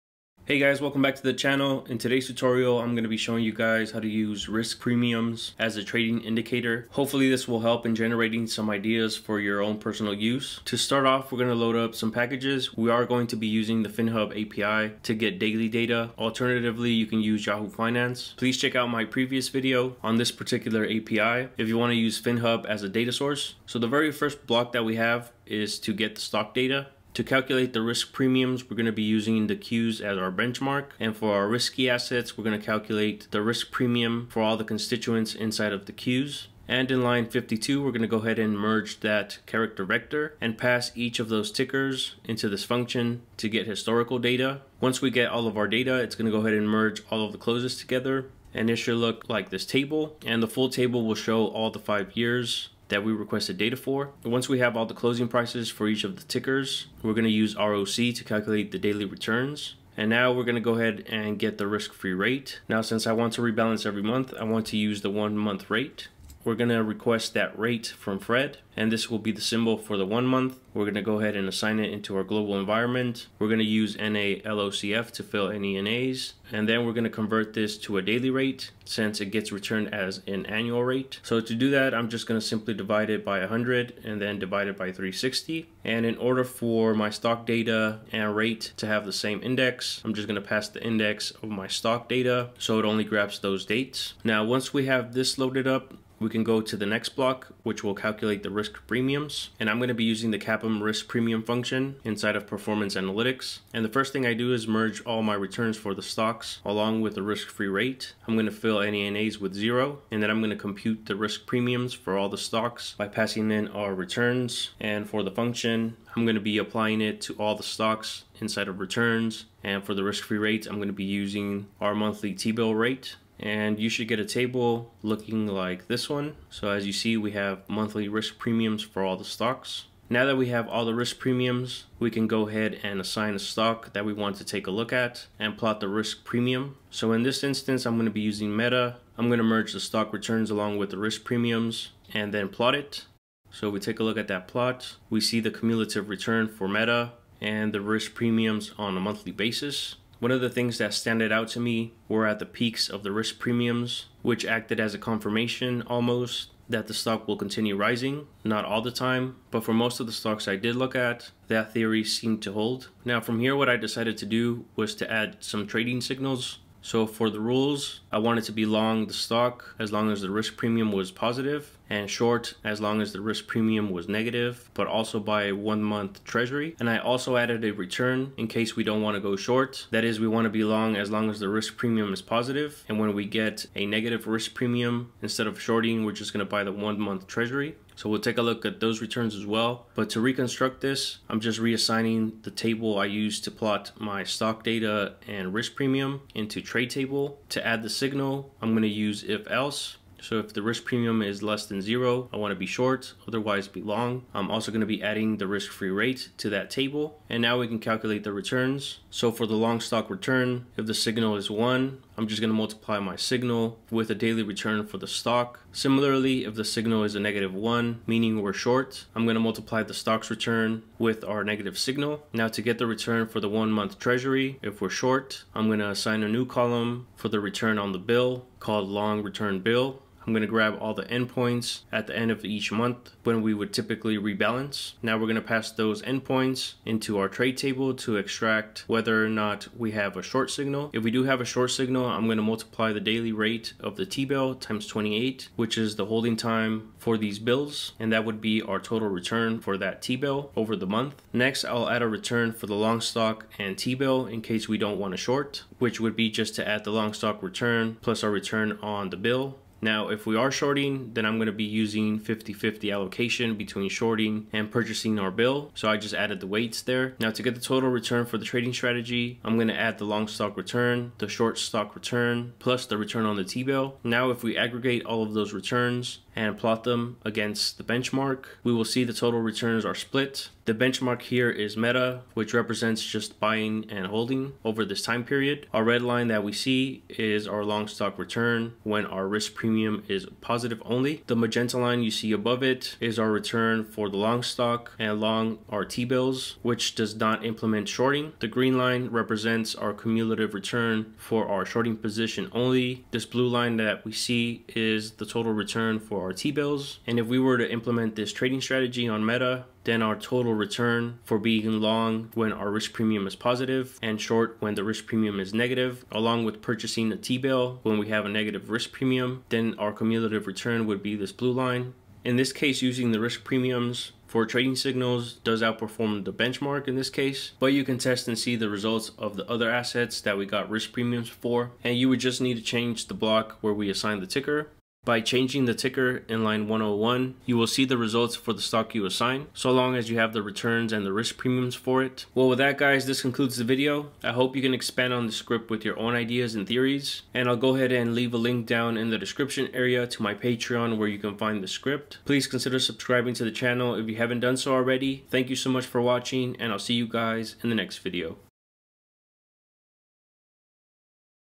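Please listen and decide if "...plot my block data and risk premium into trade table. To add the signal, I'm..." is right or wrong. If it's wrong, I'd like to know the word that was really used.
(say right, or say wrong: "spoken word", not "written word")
wrong: "stock", not "block".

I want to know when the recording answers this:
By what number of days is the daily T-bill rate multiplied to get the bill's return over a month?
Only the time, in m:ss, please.
4:04.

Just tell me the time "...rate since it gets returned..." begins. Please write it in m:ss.
1:18.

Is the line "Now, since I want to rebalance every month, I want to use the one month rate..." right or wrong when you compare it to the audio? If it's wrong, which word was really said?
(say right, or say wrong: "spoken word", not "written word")
right.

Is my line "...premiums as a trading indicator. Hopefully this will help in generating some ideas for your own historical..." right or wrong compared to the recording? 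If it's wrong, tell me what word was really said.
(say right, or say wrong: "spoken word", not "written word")
wrong: "personal", not "historical".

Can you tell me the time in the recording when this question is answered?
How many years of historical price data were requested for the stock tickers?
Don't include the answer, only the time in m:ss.
0:51.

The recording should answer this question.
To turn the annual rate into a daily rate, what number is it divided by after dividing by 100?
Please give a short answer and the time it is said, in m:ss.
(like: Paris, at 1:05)
360, at 1:24.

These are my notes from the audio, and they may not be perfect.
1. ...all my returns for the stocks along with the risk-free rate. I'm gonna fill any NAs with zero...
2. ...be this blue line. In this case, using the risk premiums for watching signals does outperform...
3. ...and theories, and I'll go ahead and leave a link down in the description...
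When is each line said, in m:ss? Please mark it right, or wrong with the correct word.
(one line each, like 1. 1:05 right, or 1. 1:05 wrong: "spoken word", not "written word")
1. 1:45 right
2. 5:21 wrong: "trading", not "watching"
3. 5:46 right.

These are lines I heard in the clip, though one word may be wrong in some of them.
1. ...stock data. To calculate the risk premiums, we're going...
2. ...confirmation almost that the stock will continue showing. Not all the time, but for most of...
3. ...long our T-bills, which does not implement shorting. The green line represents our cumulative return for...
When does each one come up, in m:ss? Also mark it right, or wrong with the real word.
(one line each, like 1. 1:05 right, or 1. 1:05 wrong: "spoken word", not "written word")
1. 0:26 right
2. 2:34 wrong: "rising", not "showing"
3. 4:55 right.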